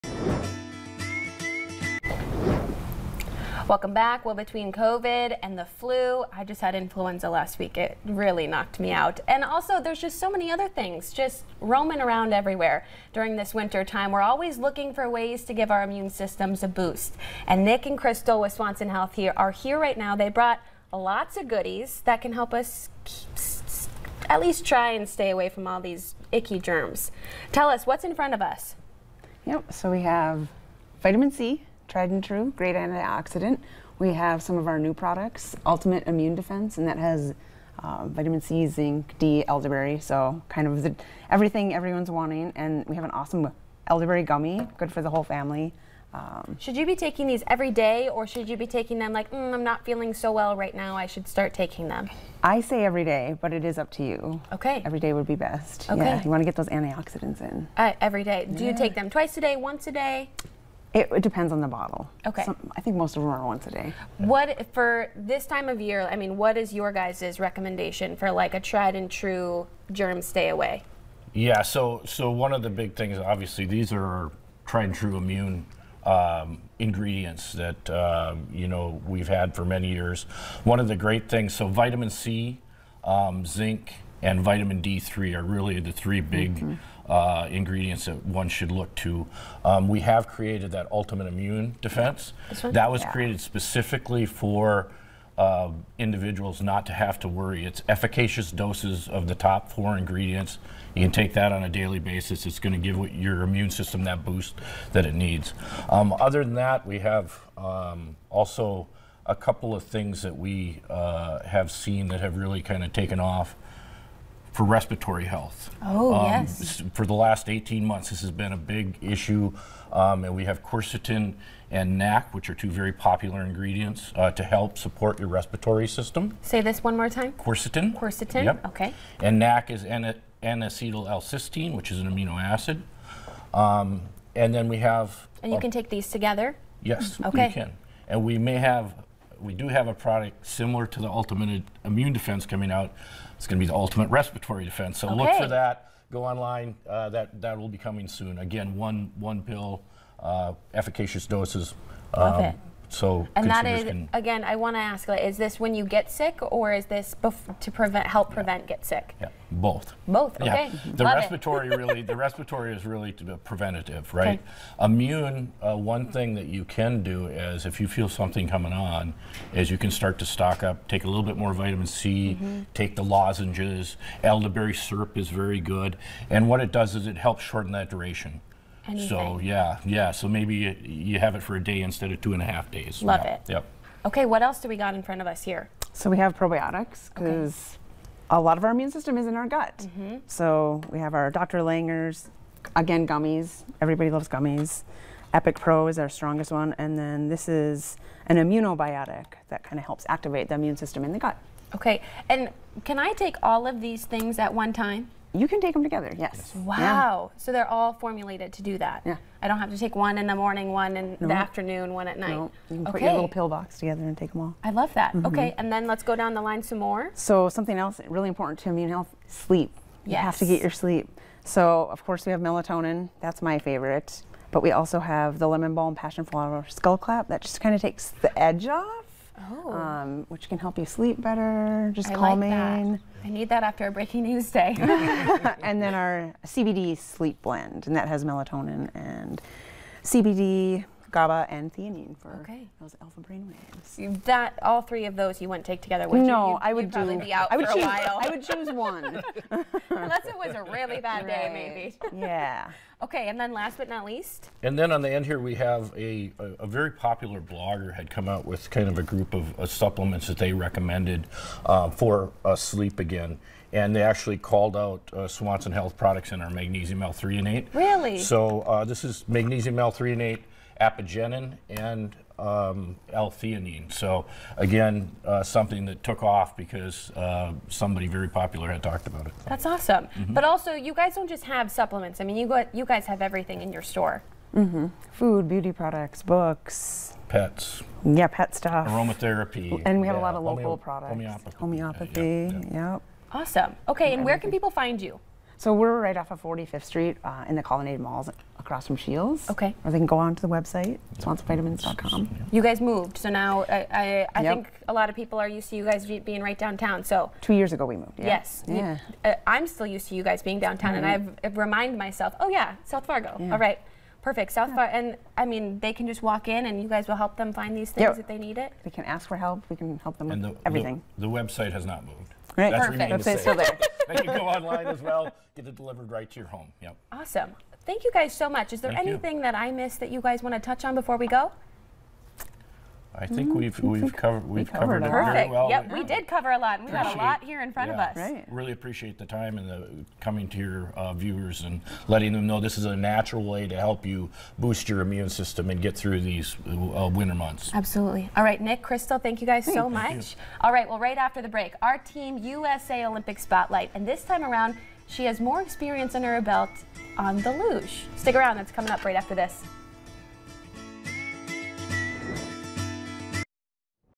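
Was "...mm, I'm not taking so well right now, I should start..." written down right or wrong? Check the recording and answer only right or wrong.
wrong.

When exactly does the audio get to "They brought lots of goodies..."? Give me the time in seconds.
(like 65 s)
20 s.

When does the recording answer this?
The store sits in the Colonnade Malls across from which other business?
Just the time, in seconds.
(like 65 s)
298 s.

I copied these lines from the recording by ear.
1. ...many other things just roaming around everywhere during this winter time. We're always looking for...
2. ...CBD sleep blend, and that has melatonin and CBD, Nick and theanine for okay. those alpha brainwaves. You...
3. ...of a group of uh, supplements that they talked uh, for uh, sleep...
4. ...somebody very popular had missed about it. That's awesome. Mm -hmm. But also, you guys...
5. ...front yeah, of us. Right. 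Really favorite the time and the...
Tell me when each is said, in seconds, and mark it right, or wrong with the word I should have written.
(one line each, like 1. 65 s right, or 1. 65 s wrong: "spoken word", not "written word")
1. 10 s right
2. 236 s wrong: "GABA", not "Nick"
3. 258 s wrong: "recommended", not "talked"
4. 277 s wrong: "talked", not "missed"
5. 337 s wrong: "appreciate", not "favorite".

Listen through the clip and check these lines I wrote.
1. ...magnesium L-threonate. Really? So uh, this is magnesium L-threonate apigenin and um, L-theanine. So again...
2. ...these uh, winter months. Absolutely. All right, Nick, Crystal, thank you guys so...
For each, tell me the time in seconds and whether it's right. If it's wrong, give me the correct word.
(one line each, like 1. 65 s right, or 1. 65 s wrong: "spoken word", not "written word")
1. 266 s right
2. 346 s right.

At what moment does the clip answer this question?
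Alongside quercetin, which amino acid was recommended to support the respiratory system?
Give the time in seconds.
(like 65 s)
129 s.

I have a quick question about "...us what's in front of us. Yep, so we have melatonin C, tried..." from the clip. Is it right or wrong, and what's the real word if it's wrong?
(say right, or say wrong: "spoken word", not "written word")
wrong: "vitamin", not "melatonin".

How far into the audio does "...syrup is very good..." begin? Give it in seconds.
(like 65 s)
174 s.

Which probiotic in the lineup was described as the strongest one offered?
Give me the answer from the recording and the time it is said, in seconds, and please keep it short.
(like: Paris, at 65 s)
Epic Pro, at 195 s.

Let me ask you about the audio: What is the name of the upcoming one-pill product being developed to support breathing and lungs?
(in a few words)
Ultimate Respiratory Defense.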